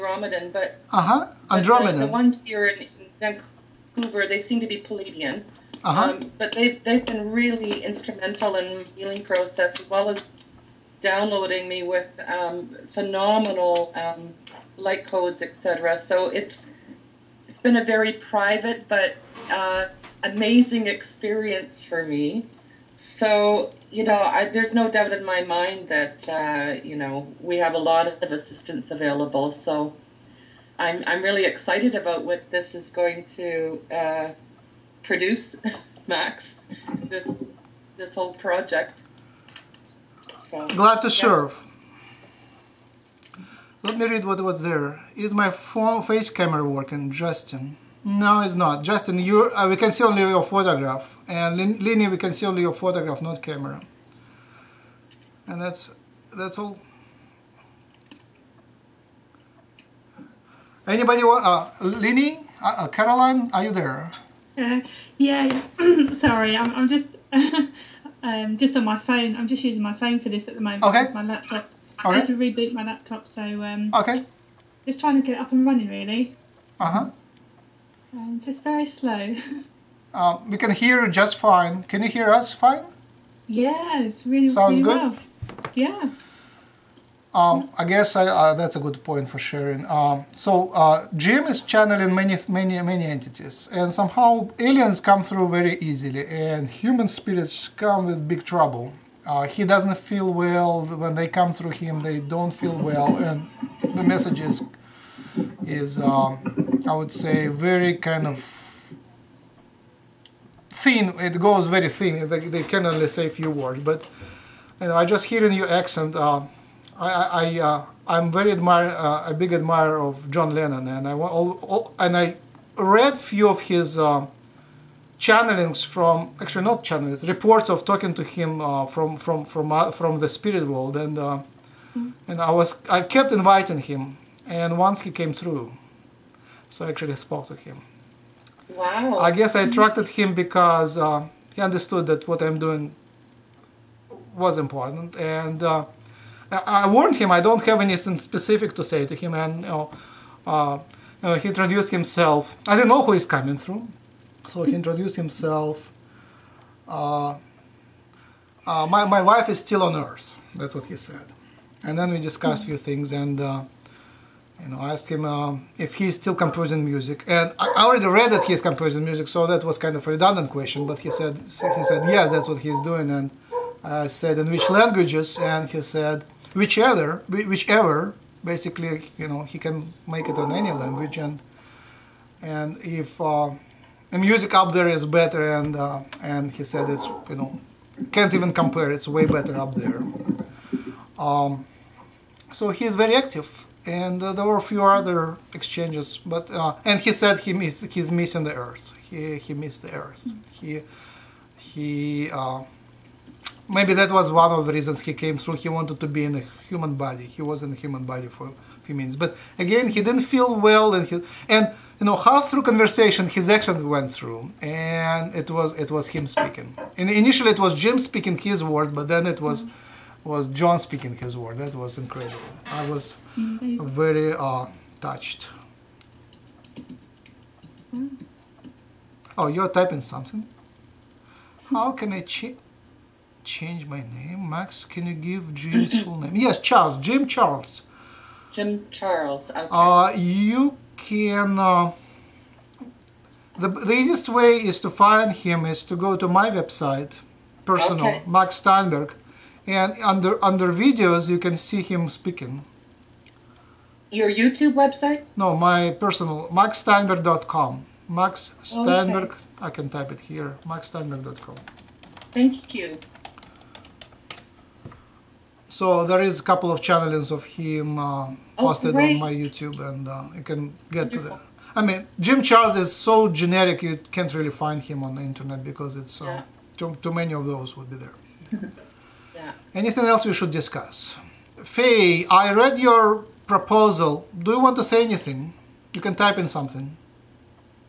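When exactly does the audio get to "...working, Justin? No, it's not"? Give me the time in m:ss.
0:46.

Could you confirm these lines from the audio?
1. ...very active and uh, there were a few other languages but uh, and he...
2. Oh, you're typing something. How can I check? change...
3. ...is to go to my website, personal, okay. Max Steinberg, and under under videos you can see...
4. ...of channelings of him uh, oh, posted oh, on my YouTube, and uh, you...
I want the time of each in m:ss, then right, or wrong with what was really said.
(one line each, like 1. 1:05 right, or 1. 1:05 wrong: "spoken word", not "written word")
1. 3:12 wrong: "exchanges", not "languages"
2. 3:49 right
3. 4:05 right
4. 4:26 right.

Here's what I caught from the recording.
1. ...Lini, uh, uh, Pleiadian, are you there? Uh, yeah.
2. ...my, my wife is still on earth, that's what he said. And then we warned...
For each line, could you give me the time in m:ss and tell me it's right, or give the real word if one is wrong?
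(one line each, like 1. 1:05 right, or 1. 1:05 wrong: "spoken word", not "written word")
1. 1:01 wrong: "Caroline", not "Pleiadian"
2. 2:38 wrong: "discussed", not "warned".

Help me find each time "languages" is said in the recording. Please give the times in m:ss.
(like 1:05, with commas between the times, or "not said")
2:54, 3:00.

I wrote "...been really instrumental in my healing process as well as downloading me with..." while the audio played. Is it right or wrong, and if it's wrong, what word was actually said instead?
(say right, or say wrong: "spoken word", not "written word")
right.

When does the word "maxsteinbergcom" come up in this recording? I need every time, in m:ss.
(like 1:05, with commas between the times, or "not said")
4:16, 4:20.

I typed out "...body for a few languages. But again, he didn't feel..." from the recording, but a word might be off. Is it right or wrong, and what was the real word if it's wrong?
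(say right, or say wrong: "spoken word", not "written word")
wrong: "minutes", not "languages".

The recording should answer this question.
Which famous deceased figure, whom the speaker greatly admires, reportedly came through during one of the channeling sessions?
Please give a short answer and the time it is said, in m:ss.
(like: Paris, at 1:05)
John Lennon, at 2:00.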